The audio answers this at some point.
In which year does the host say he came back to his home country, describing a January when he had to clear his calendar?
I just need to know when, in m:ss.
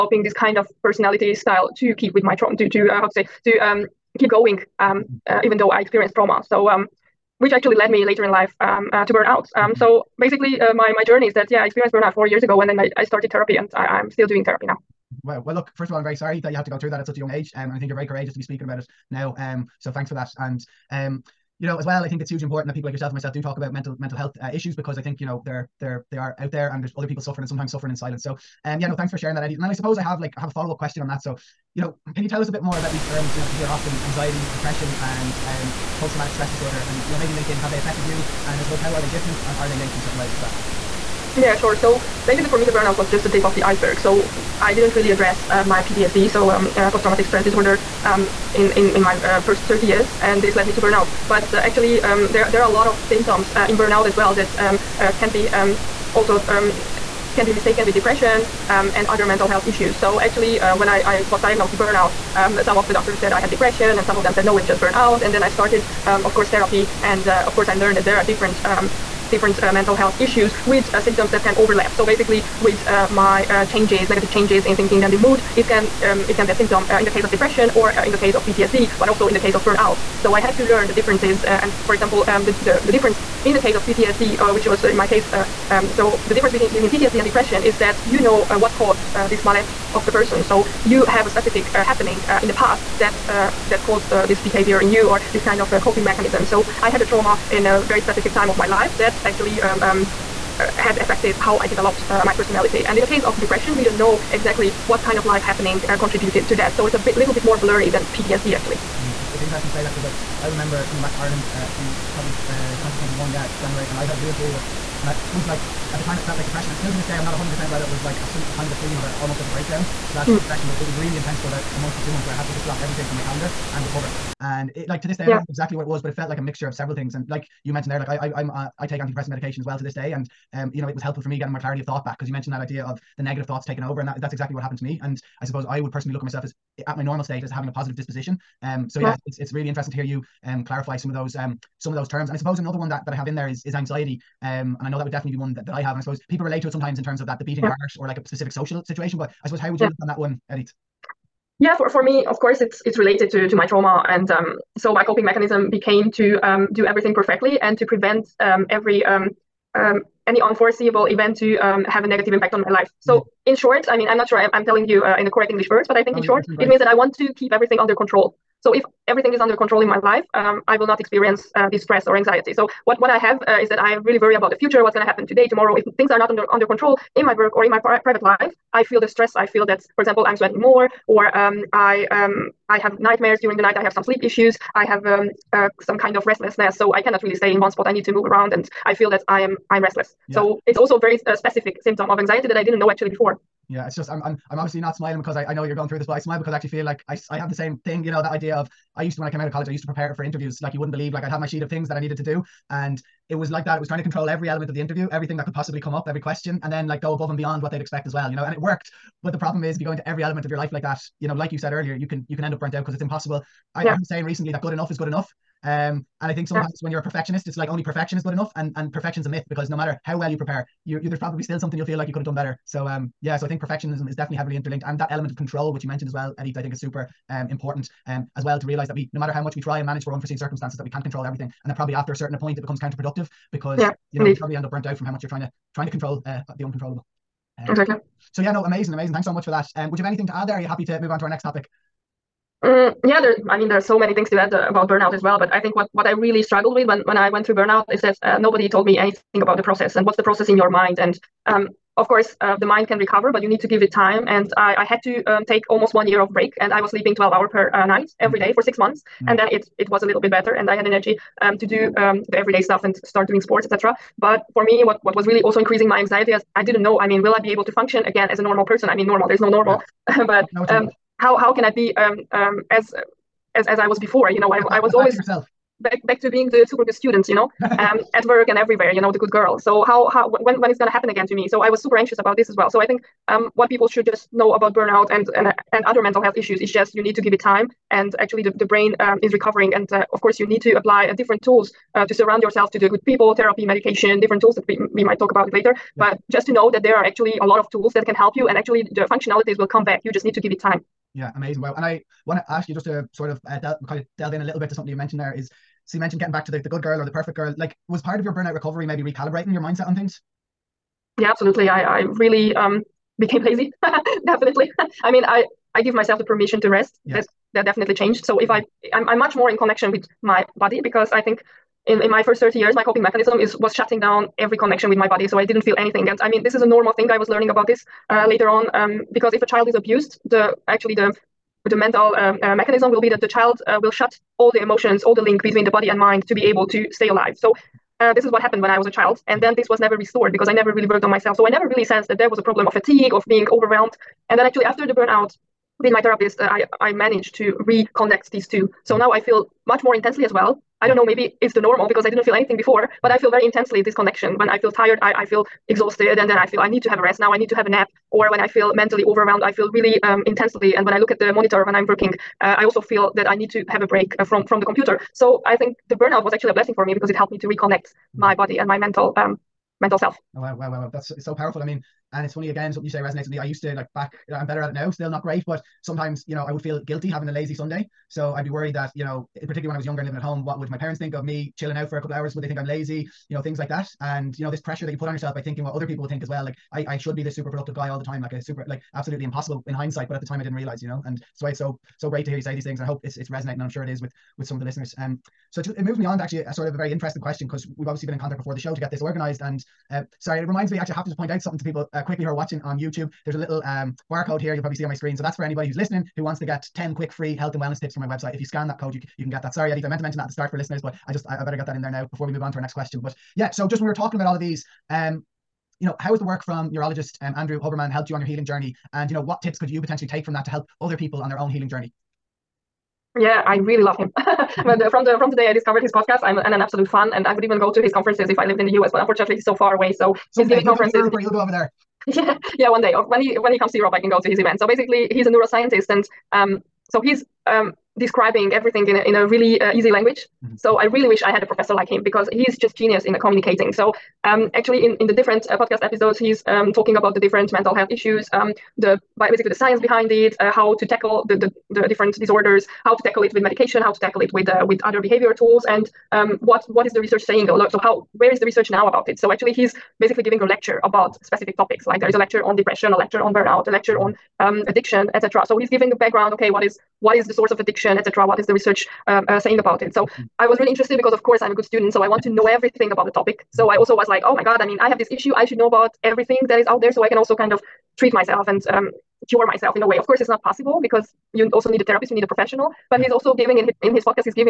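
1:52.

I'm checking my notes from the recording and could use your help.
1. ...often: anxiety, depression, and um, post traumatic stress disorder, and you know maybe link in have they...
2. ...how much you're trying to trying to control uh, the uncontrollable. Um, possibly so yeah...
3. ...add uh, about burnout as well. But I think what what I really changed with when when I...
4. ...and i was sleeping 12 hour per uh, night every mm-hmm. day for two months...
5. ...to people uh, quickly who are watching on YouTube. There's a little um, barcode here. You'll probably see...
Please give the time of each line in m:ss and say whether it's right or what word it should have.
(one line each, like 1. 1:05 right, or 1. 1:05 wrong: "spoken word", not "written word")
1. 0:33 right
2. 3:55 wrong: "exactly", not "possibly"
3. 4:04 wrong: "struggled", not "changed"
4. 4:16 wrong: "six", not "two"
5. 6:41 right.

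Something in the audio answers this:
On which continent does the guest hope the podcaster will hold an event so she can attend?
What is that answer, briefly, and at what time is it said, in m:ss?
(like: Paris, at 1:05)
Europe, at 7:13.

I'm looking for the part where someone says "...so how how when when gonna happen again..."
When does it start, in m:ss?
4:39.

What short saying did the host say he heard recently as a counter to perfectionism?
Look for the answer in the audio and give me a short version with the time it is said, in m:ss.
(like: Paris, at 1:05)
Good enough is good enough, at 3:34.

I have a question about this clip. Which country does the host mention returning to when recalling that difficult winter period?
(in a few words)
Ireland.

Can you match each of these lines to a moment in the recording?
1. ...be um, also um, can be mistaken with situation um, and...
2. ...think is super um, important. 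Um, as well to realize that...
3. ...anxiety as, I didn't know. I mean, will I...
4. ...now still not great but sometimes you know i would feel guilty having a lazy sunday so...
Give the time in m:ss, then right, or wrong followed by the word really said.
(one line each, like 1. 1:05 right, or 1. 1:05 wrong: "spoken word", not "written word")
1. 0:55 wrong: "depression", not "situation"
2. 3:46 right
3. 4:26 right
4. 6:14 right.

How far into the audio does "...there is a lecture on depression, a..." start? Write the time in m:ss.
7:42.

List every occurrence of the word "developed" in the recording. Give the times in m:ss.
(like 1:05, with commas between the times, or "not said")
1:41.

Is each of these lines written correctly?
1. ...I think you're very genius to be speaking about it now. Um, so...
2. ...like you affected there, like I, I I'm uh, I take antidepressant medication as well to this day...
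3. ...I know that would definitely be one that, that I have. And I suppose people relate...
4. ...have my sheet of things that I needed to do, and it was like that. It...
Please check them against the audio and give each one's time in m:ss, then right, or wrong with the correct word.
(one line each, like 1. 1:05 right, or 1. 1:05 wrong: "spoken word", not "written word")
1. 0:17 wrong: "courageous", not "genius"
2. 2:07 wrong: "mentioned", not "affected"
3. 2:24 right
4. 3:21 right.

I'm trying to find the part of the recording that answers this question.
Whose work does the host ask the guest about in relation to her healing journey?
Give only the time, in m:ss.
6:57.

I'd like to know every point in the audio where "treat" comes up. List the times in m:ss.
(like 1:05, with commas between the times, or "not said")
7:57.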